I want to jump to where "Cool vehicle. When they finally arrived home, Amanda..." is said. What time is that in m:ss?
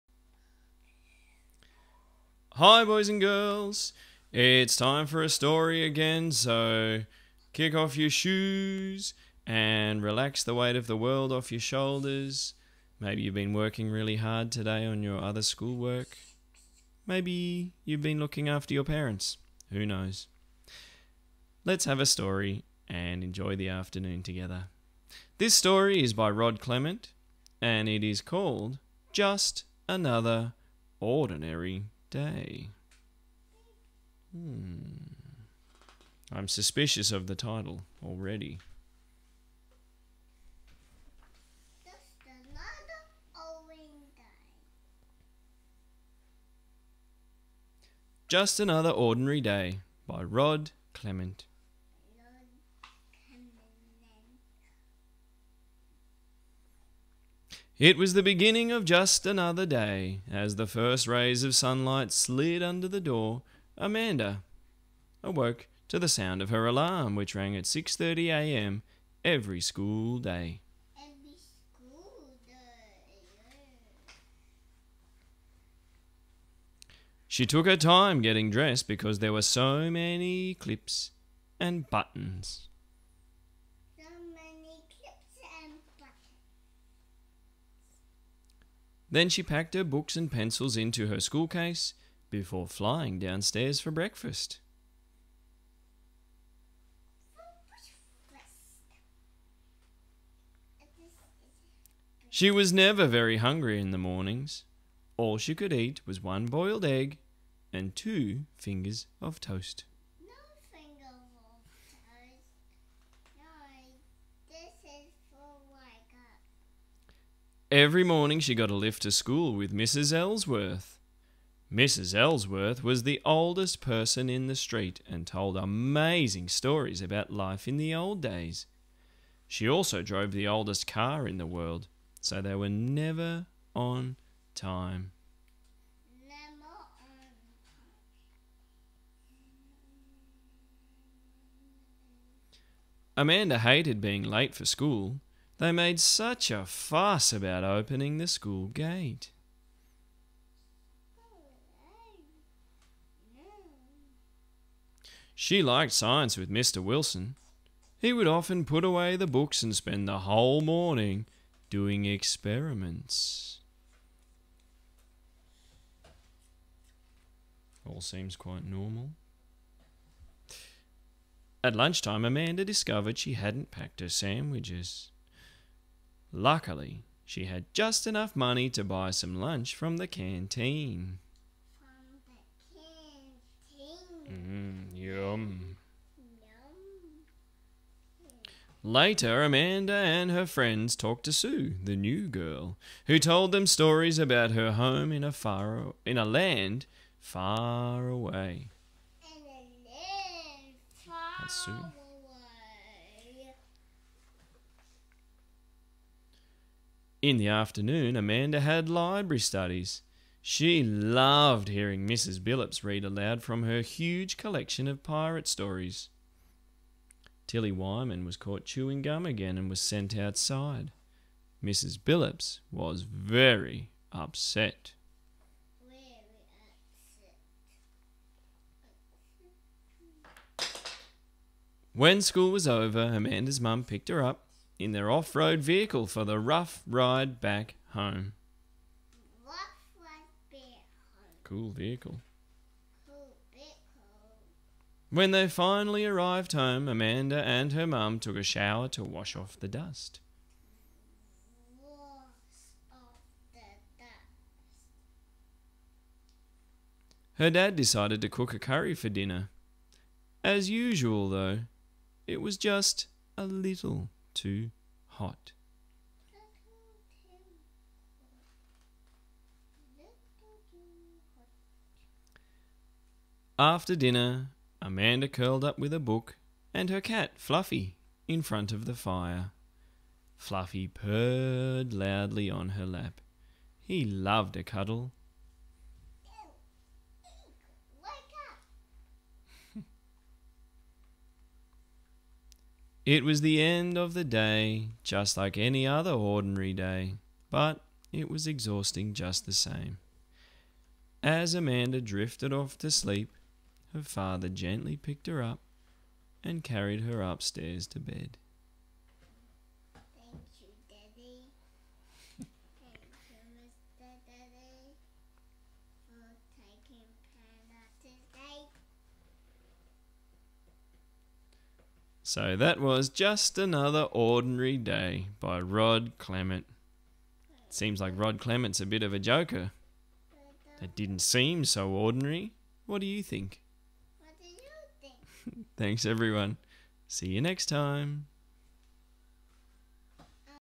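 4:01.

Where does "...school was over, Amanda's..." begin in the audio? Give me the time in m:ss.
3:52.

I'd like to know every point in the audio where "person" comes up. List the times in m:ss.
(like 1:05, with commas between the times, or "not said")
2:03.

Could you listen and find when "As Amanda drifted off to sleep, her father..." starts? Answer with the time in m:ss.
5:01.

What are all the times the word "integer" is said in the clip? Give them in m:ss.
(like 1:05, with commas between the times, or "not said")
not said.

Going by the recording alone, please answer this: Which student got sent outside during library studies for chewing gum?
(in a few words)
Tilly Wyman.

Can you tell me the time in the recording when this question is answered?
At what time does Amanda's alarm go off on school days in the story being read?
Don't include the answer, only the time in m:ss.
1:07.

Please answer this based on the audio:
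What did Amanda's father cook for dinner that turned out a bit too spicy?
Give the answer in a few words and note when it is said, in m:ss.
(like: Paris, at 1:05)
Curry, at 4:18.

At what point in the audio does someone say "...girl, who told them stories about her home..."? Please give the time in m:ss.
3:12.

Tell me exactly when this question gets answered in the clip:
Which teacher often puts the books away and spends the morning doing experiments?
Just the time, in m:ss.
2:36.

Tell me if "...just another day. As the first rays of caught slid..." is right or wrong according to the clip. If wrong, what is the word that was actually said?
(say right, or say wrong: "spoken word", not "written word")
wrong: "sunlight", not "caught".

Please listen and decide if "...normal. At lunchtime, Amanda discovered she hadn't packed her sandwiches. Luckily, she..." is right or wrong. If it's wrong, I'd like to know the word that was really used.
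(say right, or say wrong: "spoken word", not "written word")
right.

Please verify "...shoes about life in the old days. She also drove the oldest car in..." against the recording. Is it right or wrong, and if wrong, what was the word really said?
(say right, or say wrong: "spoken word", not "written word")
wrong: "stories", not "shoes".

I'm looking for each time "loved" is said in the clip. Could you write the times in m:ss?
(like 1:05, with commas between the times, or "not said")
3:30, 4:44.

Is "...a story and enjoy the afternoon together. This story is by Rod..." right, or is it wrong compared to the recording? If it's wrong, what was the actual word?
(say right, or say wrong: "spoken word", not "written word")
right.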